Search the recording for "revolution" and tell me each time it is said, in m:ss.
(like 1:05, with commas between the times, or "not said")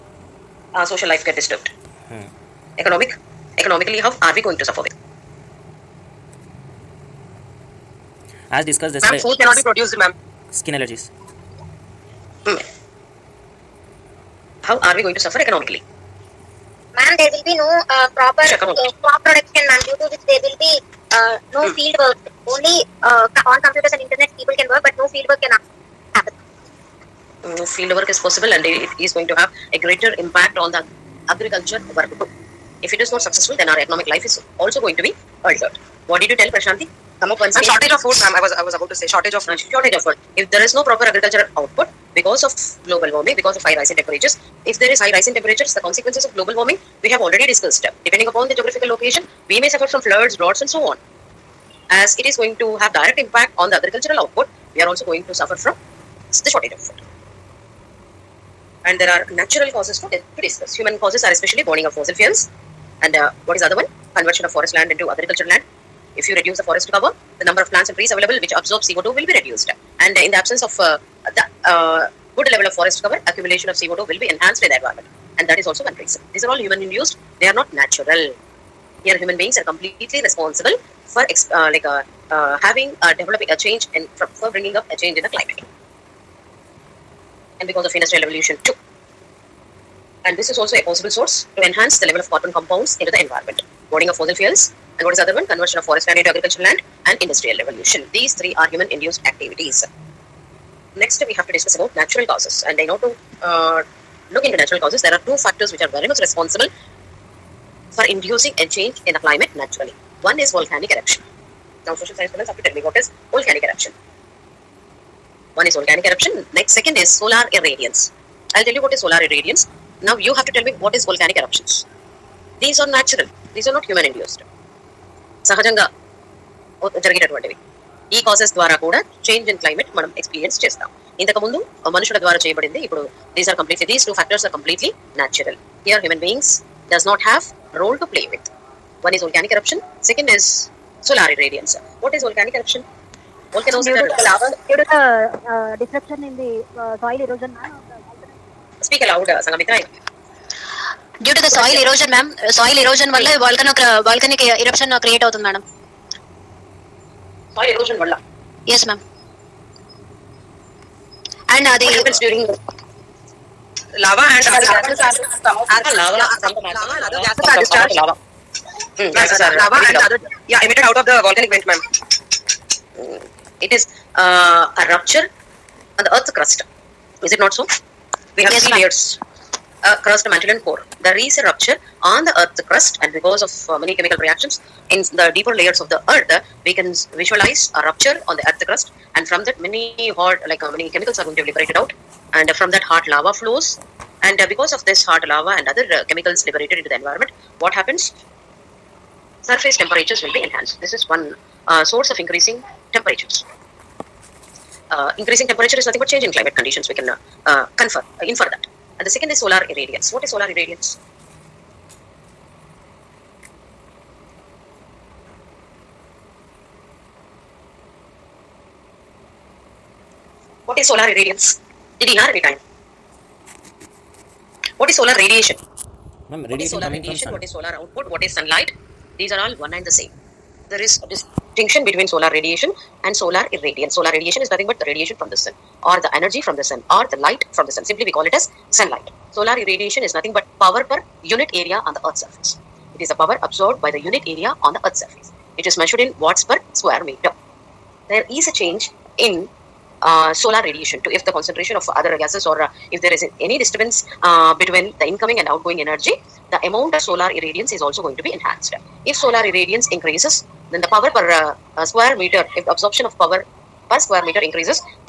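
1:28, 1:37.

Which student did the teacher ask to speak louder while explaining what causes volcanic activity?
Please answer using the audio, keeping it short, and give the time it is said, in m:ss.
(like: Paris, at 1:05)
Sangamitra, at 2:29.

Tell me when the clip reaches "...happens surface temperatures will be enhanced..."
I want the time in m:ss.
3:17.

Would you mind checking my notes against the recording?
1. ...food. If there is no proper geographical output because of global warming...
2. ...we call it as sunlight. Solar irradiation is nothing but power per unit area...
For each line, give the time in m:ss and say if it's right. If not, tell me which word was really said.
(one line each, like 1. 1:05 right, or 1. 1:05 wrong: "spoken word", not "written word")
1. 0:39 wrong: "agricultural", not "geographical"
2. 3:58 right.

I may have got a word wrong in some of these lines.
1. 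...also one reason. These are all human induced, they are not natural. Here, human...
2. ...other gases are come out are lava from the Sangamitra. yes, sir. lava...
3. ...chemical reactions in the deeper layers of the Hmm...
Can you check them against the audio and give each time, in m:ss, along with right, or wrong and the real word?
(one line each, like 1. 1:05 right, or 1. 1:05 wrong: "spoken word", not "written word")
1. 1:15 right
2. 2:44 wrong: "Hmm", not "Sangamitra"
3. 3:03 wrong: "Earth", not "Hmm".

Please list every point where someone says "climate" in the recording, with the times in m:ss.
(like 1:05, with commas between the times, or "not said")
1:25, 1:49, 3:26.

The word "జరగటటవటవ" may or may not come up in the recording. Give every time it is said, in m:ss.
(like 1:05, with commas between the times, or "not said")
2:07.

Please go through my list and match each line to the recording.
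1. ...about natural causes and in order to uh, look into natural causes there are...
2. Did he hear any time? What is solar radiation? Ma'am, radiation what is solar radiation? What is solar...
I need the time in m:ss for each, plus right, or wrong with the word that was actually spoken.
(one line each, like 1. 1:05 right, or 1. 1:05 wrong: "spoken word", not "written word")
1. 1:41 right
2. 3:41 right.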